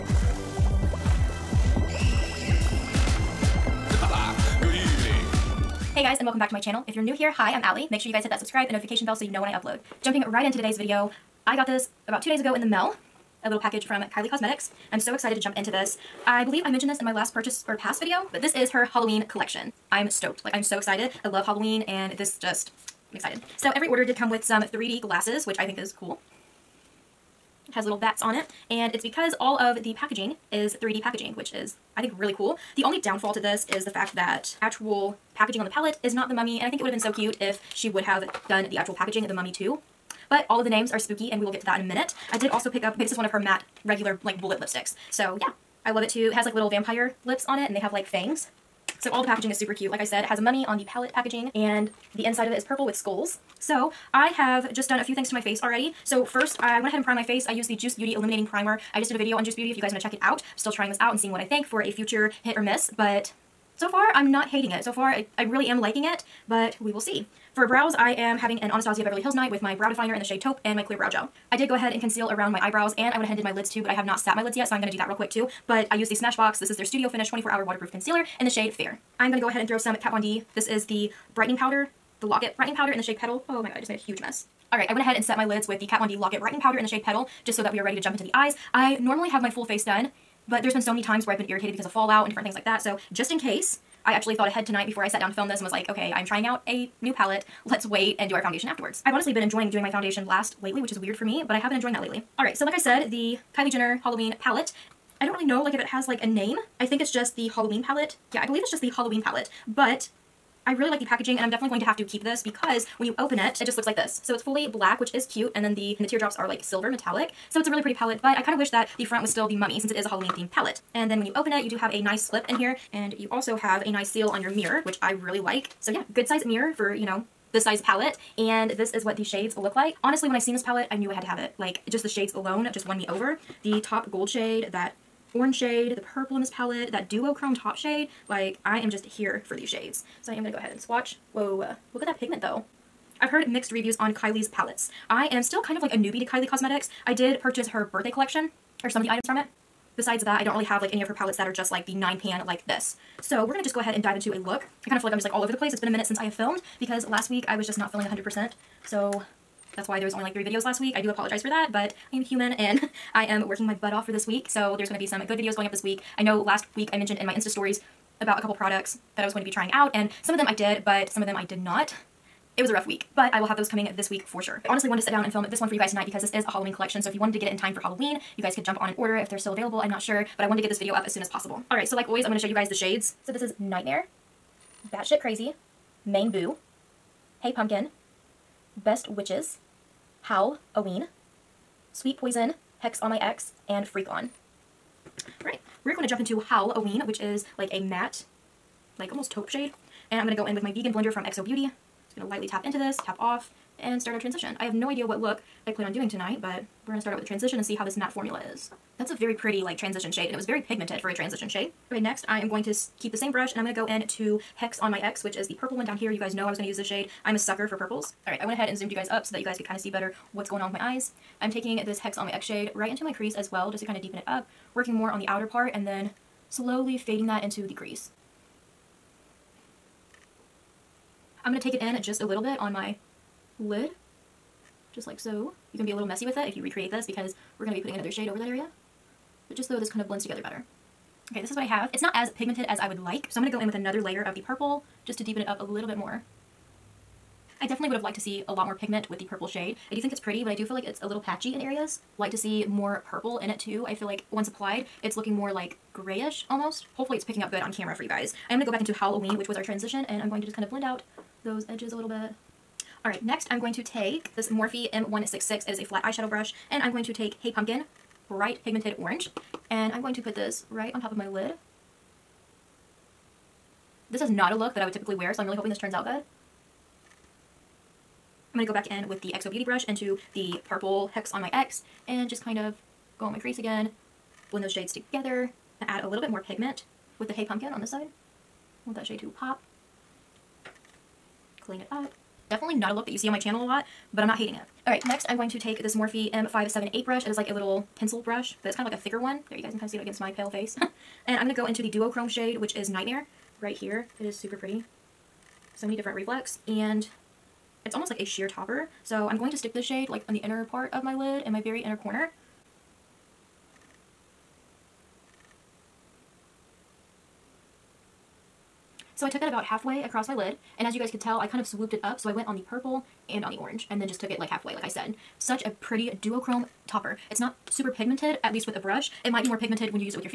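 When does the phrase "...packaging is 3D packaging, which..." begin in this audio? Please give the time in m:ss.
0:29.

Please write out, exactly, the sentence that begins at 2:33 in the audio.
So we're gonna just go ahead and dive into a look.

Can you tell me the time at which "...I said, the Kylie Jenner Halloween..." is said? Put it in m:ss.
1:42.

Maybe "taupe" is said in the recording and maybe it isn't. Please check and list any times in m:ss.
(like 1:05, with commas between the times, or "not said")
1:10, 3:19.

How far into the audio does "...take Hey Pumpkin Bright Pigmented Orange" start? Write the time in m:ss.
4:27.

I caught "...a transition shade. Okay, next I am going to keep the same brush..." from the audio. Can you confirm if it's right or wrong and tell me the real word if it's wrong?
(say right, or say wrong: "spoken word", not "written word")
right.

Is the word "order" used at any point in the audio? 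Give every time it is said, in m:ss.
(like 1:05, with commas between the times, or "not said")
0:23, 2:58.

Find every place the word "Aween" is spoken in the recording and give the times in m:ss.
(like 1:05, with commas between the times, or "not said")
3:10, 3:16.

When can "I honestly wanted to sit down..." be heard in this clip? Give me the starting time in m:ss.
2:54.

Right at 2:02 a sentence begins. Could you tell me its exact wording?
And you also have a nice seal on your mirror, which I really like.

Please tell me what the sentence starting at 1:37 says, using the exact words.
Let's wait and do our foundation afterwards.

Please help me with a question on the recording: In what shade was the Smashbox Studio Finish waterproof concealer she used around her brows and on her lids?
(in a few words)
Fair.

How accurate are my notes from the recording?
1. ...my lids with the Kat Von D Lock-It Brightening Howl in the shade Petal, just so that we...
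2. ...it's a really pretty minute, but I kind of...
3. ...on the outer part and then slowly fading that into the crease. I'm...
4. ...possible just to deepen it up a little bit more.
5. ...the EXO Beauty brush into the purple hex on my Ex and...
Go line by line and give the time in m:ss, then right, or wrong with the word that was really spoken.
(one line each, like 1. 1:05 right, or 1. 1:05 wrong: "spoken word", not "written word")
1. 1:25 wrong: "Powder", not "Howl"
2. 1:57 wrong: "palette", not "minute"
3. 3:45 right
4. 4:04 wrong: "purple", not "possible"
5. 4:39 right.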